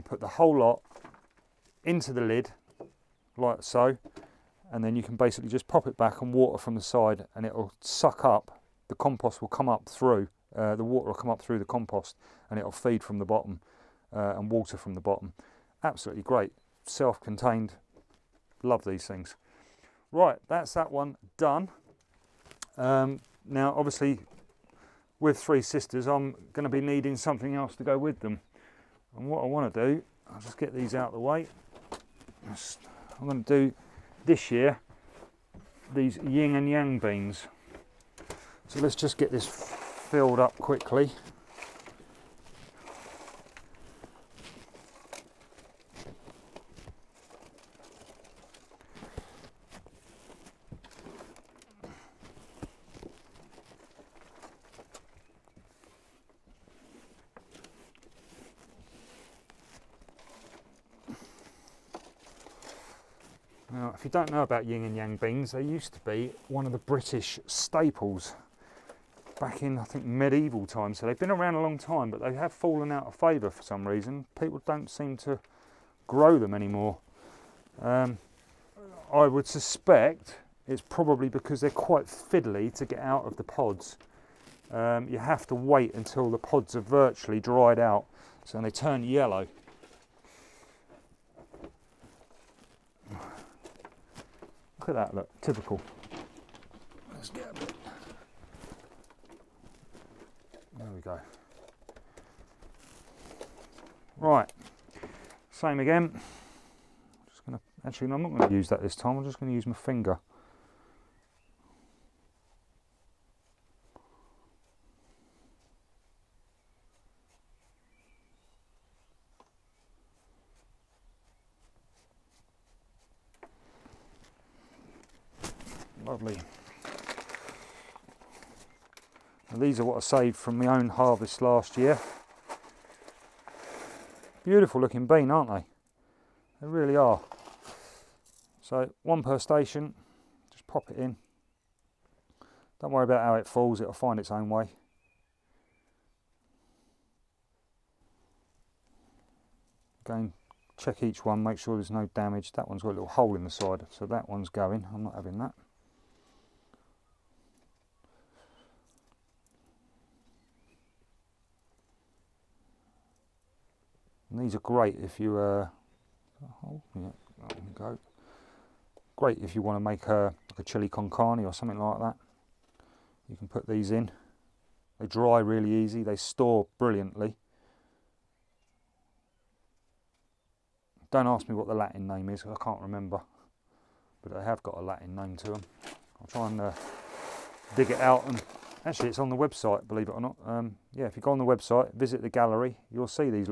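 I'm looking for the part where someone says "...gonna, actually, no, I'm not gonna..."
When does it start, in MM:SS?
01:47.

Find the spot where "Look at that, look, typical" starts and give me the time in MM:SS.
01:34.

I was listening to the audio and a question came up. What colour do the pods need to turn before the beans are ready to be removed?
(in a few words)
Yellow.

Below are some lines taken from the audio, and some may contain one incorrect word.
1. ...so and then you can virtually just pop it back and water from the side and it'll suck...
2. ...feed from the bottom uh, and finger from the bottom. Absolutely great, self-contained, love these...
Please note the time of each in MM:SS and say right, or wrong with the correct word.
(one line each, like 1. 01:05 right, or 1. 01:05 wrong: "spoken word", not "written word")
1. 00:03 wrong: "basically", not "virtually"
2. 00:12 wrong: "water", not "finger".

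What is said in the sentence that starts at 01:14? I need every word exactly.
People don't seem to grow them anymore.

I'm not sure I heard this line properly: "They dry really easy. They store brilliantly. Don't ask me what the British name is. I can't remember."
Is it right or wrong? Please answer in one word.
wrong.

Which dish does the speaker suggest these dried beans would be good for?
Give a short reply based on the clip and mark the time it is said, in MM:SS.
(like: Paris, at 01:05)
Chili con carne, at 02:50.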